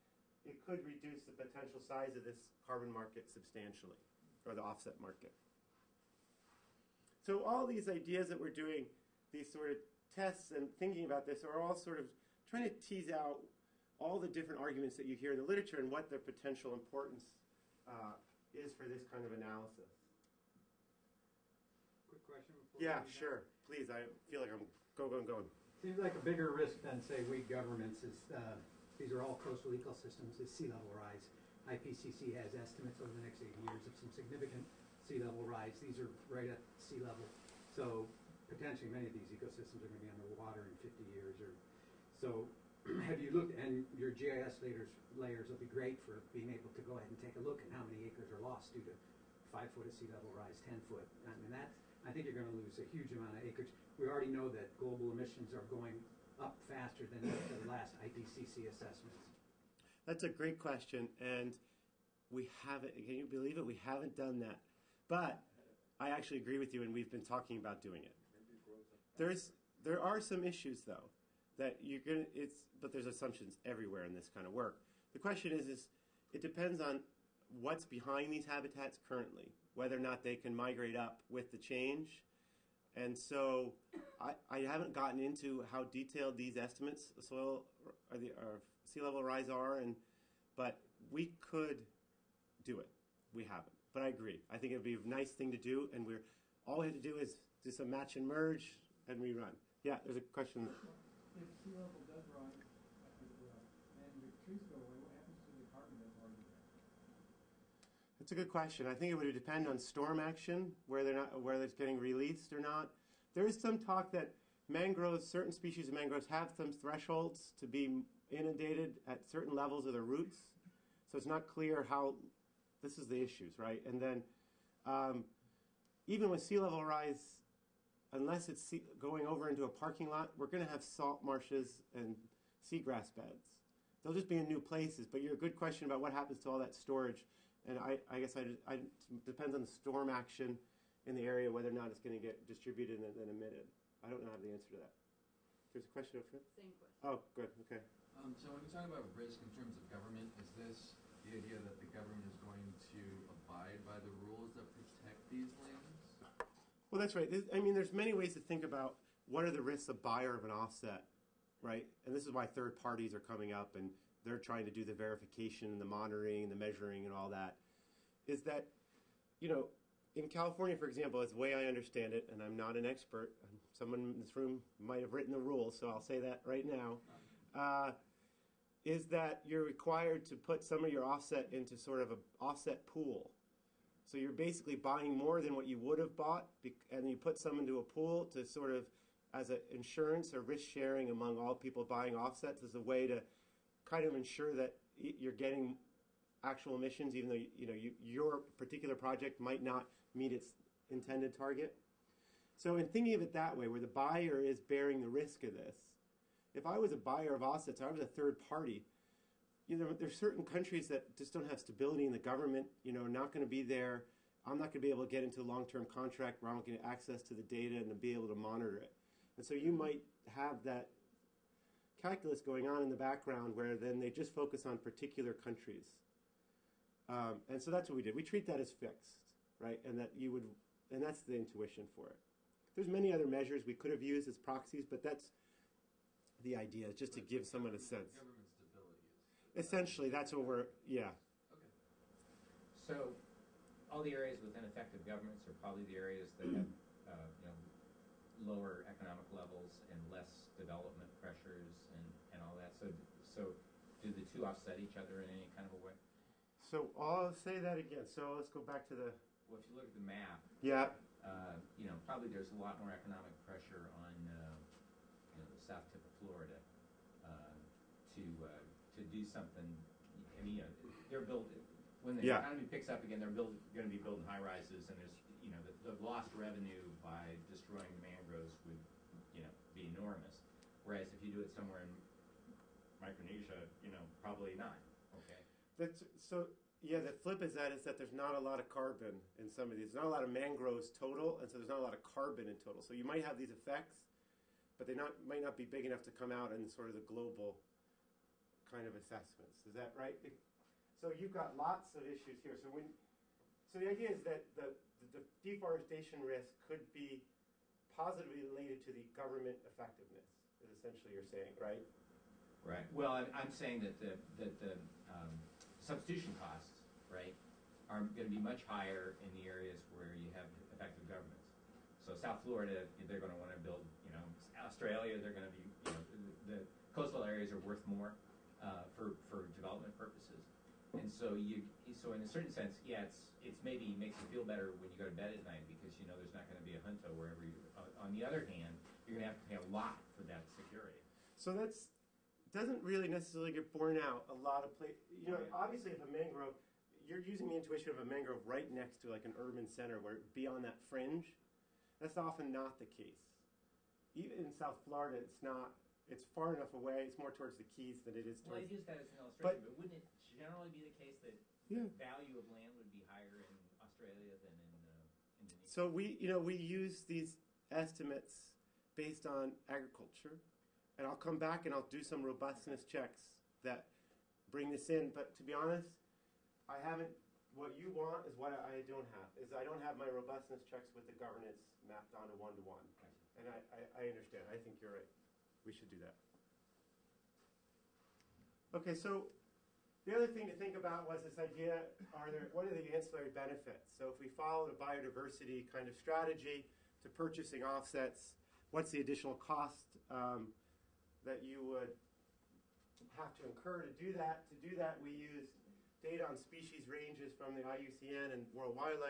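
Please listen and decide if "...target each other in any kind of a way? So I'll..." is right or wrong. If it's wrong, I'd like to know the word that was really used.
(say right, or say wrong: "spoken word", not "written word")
wrong: "offset", not "target".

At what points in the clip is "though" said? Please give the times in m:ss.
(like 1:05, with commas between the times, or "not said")
1:10, 3:17.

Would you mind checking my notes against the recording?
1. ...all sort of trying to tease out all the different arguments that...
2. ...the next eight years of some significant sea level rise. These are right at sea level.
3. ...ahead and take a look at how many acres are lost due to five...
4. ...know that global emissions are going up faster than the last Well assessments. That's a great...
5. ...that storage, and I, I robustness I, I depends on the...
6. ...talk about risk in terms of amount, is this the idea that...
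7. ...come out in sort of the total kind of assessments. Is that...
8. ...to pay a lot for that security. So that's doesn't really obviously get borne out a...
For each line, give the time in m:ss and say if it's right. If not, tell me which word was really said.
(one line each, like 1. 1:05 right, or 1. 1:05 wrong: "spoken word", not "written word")
1. 0:11 right
2. 0:33 right
3. 0:46 right
4. 0:54 wrong: "IPCC", not "Well"
5. 2:16 wrong: "guess", not "robustness"
6. 2:28 wrong: "government", not "amount"
7. 4:56 wrong: "global", not "total"
8. 5:39 wrong: "necessarily", not "obviously".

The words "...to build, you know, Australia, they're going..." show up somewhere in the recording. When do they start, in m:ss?
5:23.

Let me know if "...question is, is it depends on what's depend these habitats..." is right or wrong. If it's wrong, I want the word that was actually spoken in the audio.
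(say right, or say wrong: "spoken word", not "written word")
wrong: "behind", not "depend".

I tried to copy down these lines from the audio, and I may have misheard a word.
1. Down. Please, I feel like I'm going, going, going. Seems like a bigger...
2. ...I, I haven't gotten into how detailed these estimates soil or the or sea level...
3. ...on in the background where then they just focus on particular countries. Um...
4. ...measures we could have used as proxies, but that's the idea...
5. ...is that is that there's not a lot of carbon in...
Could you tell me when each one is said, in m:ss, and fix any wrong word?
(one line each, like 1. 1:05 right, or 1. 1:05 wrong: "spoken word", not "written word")
1. 0:23 right
2. 1:24 right
3. 3:42 right
4. 3:53 right
5. 4:47 right.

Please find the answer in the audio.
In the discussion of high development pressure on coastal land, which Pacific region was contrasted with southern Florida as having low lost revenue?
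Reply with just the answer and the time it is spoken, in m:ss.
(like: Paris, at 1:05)
Micronesia, at 4:42.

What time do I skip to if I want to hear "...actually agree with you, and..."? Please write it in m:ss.
1:06.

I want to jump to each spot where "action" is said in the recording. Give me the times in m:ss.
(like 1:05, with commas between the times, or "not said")
1:50, 2:20.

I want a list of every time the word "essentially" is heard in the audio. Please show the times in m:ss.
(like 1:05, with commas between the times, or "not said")
3:59, 5:10.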